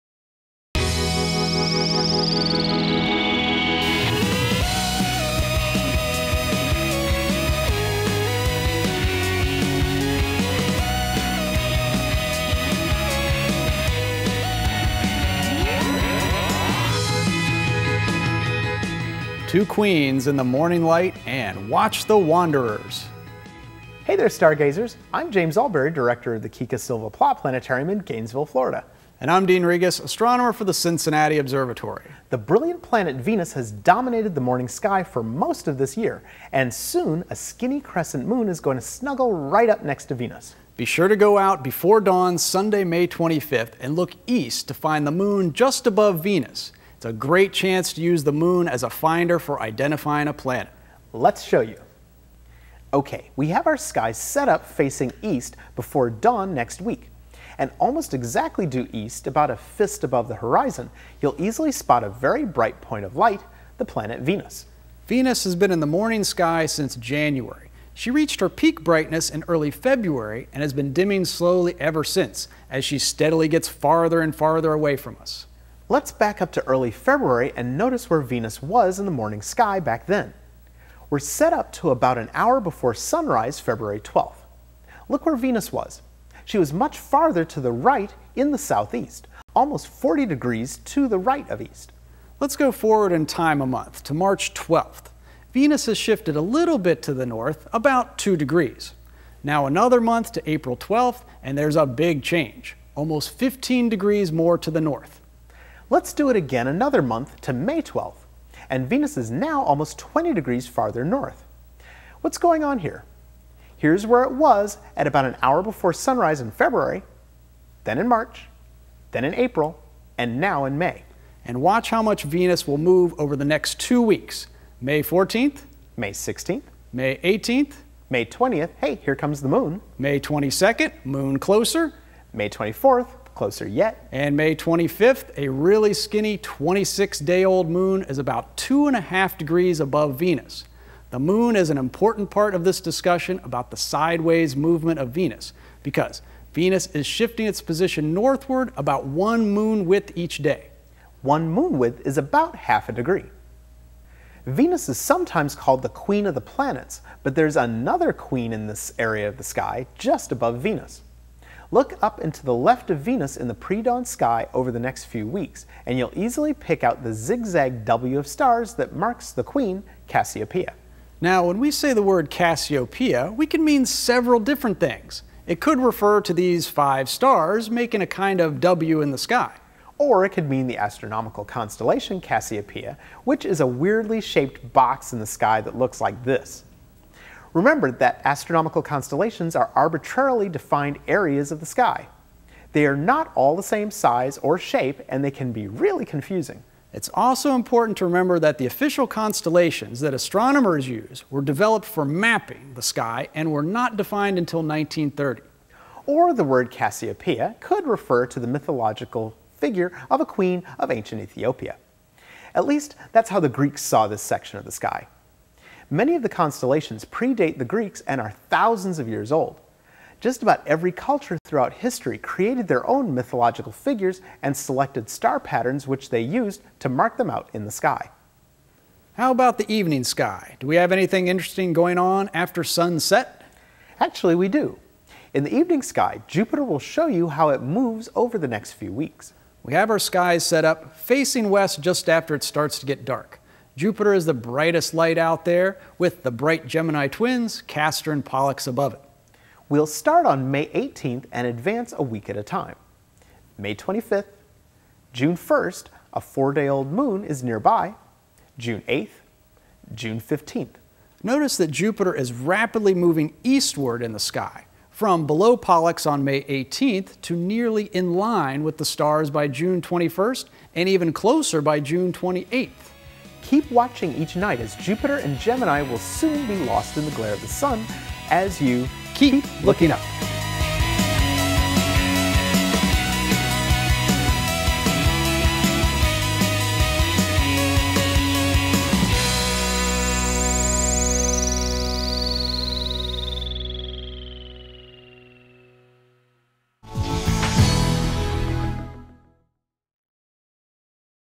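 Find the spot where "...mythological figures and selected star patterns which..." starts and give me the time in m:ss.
3:43.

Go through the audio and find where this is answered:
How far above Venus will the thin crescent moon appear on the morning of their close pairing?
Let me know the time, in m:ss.
2:18.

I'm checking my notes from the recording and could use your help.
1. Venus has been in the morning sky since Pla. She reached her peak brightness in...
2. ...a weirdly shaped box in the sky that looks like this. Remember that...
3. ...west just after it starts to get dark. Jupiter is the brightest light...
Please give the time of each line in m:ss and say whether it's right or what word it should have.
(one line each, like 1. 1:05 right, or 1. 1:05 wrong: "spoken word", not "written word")
1. 1:05 wrong: "January", not "Pla"
2. 3:03 right
3. 4:01 right.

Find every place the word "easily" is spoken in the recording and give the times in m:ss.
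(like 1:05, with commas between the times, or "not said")
1:01, 2:46.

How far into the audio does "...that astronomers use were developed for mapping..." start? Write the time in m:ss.
3:19.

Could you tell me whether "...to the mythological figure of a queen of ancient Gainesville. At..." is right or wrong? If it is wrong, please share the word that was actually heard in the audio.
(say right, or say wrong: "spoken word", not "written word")
wrong: "Ethiopia", not "Gainesville".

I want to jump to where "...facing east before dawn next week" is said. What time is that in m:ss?
0:54.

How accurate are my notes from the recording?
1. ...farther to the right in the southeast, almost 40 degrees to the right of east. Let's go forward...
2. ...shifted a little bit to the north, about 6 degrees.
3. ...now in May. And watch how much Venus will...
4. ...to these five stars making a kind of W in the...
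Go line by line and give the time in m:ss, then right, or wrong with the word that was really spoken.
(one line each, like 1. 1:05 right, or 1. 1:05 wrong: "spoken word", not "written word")
1. 1:26 right
2. 1:35 wrong: "2", not "6"
3. 2:00 right
4. 2:56 right.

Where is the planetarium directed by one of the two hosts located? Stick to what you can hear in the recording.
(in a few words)
Gainesville, Florida.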